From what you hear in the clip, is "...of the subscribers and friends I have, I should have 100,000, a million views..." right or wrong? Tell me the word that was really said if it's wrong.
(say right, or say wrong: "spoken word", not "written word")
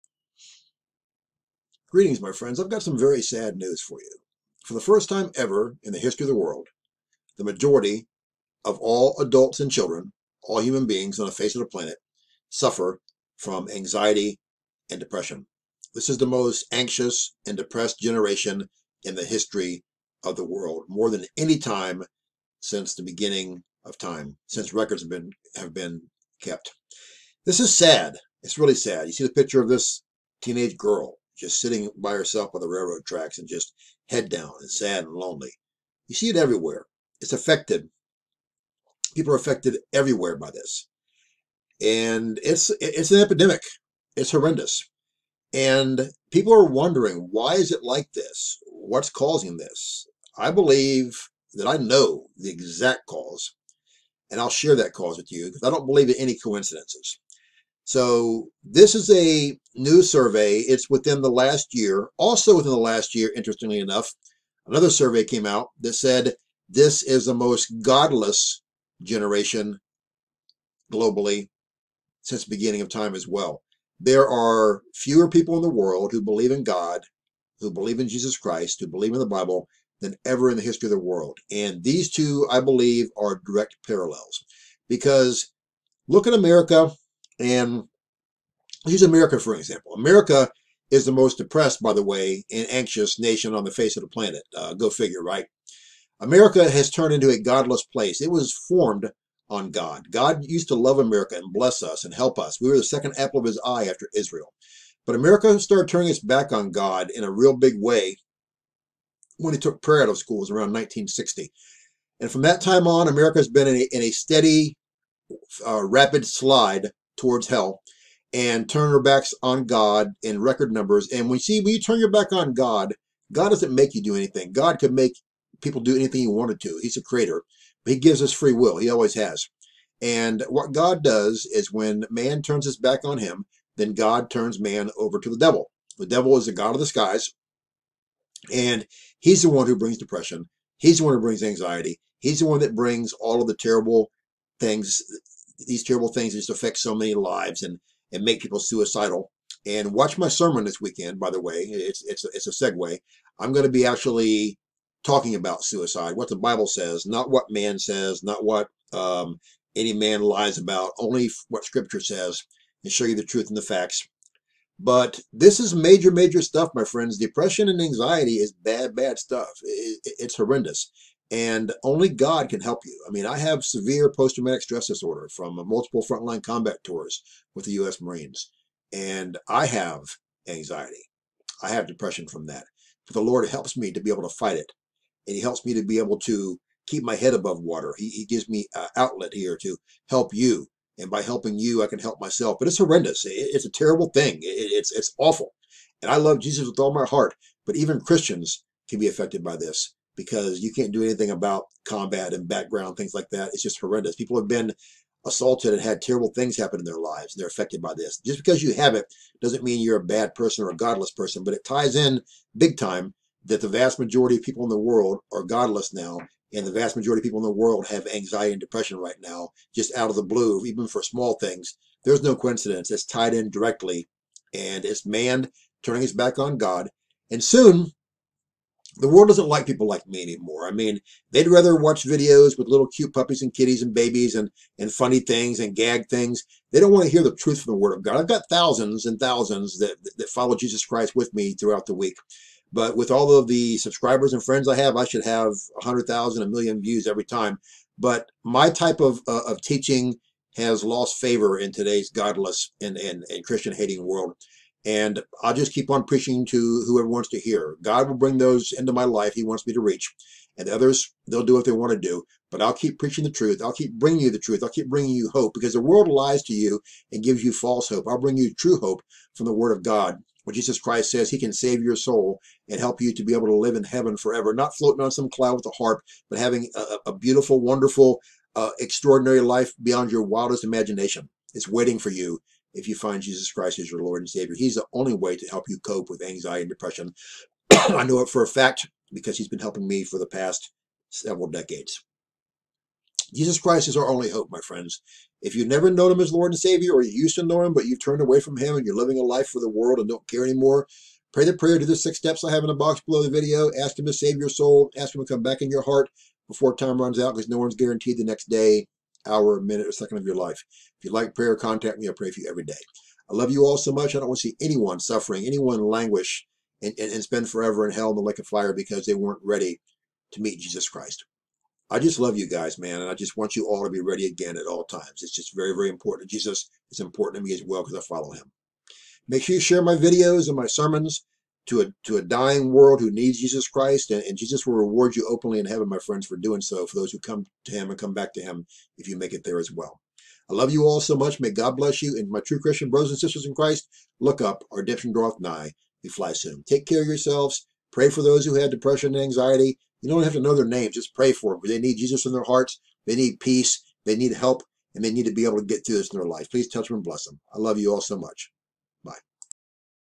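right.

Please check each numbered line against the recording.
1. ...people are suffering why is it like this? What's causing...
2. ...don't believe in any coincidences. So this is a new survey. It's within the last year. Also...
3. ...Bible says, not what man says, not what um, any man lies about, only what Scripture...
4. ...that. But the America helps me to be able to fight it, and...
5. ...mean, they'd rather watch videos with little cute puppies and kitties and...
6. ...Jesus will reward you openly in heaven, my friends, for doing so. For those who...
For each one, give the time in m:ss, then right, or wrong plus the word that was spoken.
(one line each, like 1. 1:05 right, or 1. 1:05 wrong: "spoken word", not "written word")
1. 0:46 wrong: "wondering", not "suffering"
2. 0:55 right
3. 2:36 right
4. 3:02 wrong: "Lord", not "America"
5. 3:50 right
6. 5:34 right.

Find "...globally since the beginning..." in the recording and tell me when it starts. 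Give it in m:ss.
1:10.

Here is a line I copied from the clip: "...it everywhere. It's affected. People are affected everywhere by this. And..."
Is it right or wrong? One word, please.
right.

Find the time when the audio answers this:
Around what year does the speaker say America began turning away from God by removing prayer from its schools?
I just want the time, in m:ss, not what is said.
1:50.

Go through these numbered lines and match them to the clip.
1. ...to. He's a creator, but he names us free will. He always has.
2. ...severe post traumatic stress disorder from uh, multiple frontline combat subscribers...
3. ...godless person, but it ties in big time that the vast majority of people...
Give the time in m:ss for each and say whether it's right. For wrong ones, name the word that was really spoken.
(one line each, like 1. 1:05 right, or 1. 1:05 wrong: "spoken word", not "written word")
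1. 2:06 wrong: "gives", not "names"
2. 2:53 wrong: "tours", not "subscribers"
3. 3:30 right.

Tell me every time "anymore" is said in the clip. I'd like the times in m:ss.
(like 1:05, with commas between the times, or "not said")
3:50, 5:00.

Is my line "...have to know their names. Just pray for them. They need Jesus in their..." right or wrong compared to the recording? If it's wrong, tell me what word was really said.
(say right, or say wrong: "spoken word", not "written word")
right.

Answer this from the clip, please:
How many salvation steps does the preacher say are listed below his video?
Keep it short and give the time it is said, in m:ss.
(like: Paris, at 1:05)
6, at 5:01.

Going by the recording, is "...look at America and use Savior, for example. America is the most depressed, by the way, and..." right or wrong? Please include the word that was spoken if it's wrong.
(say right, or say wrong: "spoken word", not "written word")
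wrong: "America", not "Savior".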